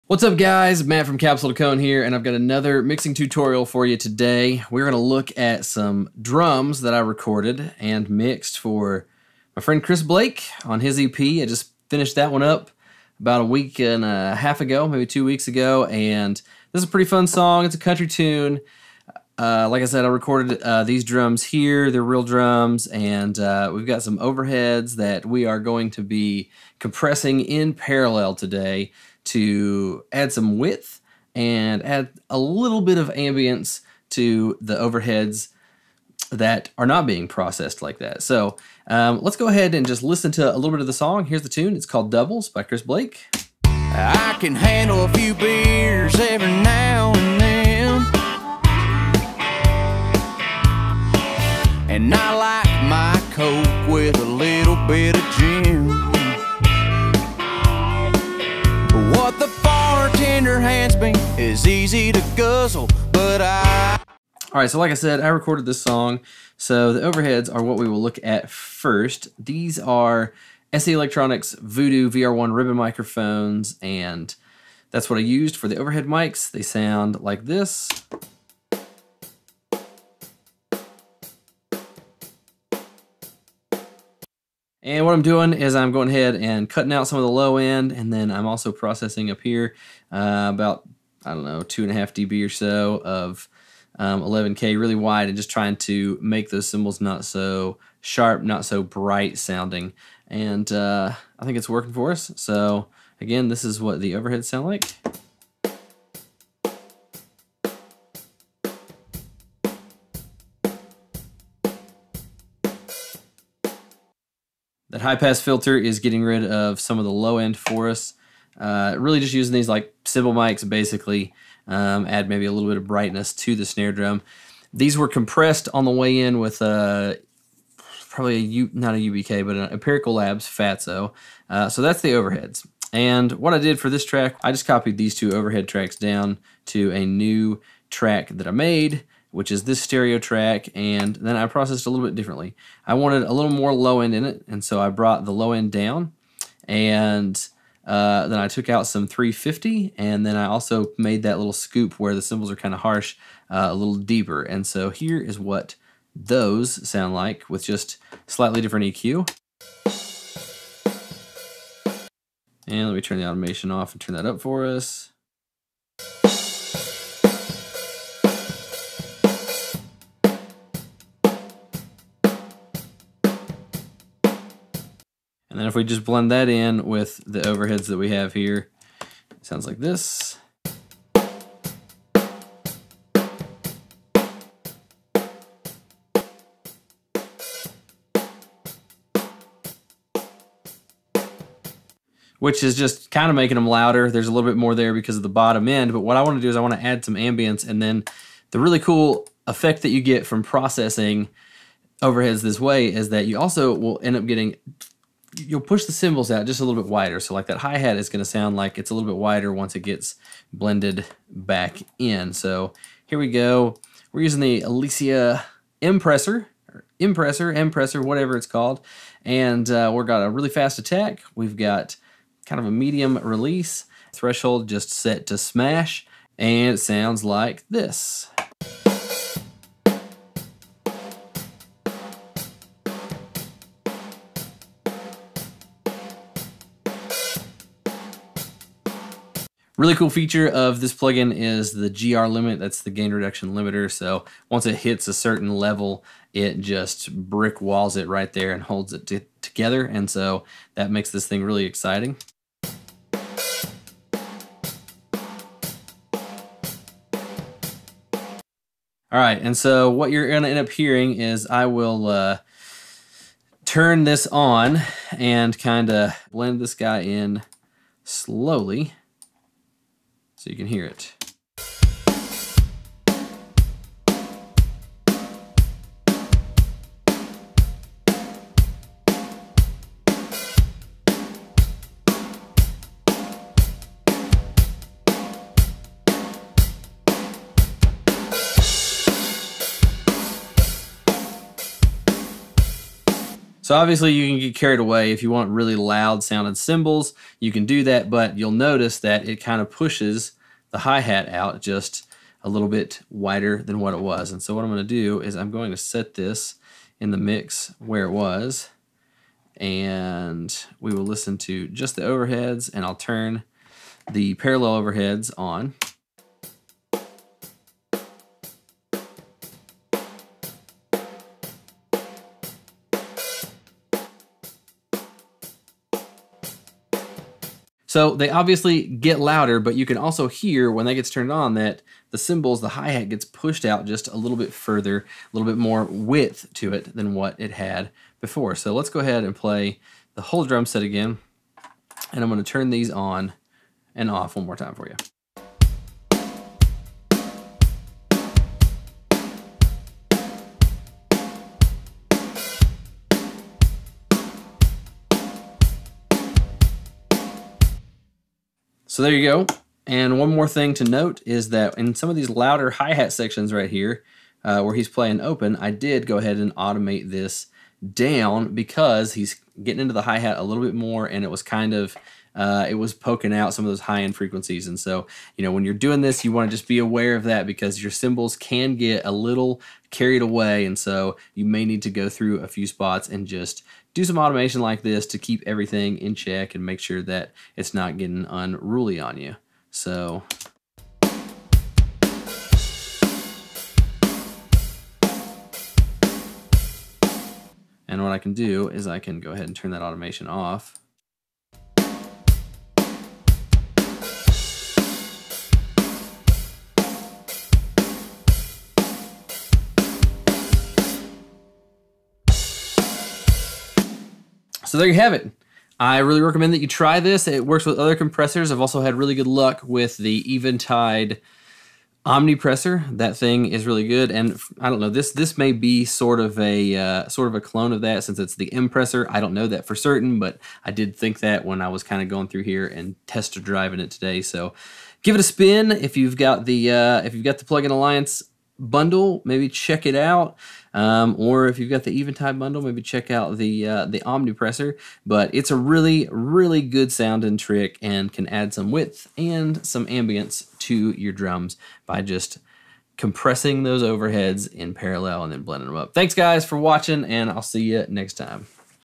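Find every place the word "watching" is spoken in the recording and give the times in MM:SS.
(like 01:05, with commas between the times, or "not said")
07:36.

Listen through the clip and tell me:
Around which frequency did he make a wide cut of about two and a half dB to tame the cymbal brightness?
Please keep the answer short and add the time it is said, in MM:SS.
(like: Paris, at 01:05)
11K, at 01:34.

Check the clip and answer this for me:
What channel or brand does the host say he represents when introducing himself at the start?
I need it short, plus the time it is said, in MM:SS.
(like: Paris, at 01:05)
Capsule to Cone, at 00:01.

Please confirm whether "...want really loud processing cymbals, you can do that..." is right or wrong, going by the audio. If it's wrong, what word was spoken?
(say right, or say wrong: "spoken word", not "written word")
wrong: "sounding", not "processing".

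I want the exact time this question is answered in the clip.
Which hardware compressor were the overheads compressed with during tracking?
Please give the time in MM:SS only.
02:09.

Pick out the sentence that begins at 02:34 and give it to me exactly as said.
And so here is what those sound like with just slightly different EQ.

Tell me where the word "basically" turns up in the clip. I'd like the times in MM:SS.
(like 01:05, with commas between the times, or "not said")
02:00.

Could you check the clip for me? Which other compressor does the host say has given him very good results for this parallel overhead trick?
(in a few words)
Eventide Omnipressor.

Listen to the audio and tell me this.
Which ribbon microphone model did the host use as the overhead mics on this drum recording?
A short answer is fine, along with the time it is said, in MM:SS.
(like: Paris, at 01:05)
SE Electronics Voodoo VR1, at 01:10.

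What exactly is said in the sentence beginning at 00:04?
We're going to look at some drums that I recorded and mixed for my friend Chris Blake on his EP.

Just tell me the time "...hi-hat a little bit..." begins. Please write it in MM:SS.
06:10.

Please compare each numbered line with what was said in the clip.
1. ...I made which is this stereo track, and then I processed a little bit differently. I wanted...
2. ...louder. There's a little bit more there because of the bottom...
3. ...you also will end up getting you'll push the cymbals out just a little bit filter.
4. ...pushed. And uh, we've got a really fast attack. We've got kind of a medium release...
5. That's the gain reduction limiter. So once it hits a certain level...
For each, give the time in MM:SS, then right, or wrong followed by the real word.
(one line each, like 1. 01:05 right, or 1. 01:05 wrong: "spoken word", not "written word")
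1. 02:18 right
2. 03:13 right
3. 03:23 wrong: "wider", not "filter"
4. 03:38 wrong: "called", not "pushed"
5. 04:02 right.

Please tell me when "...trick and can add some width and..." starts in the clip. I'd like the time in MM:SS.
07:27.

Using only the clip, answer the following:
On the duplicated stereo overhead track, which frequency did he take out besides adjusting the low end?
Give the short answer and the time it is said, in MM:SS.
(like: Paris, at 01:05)
350, at 02:29.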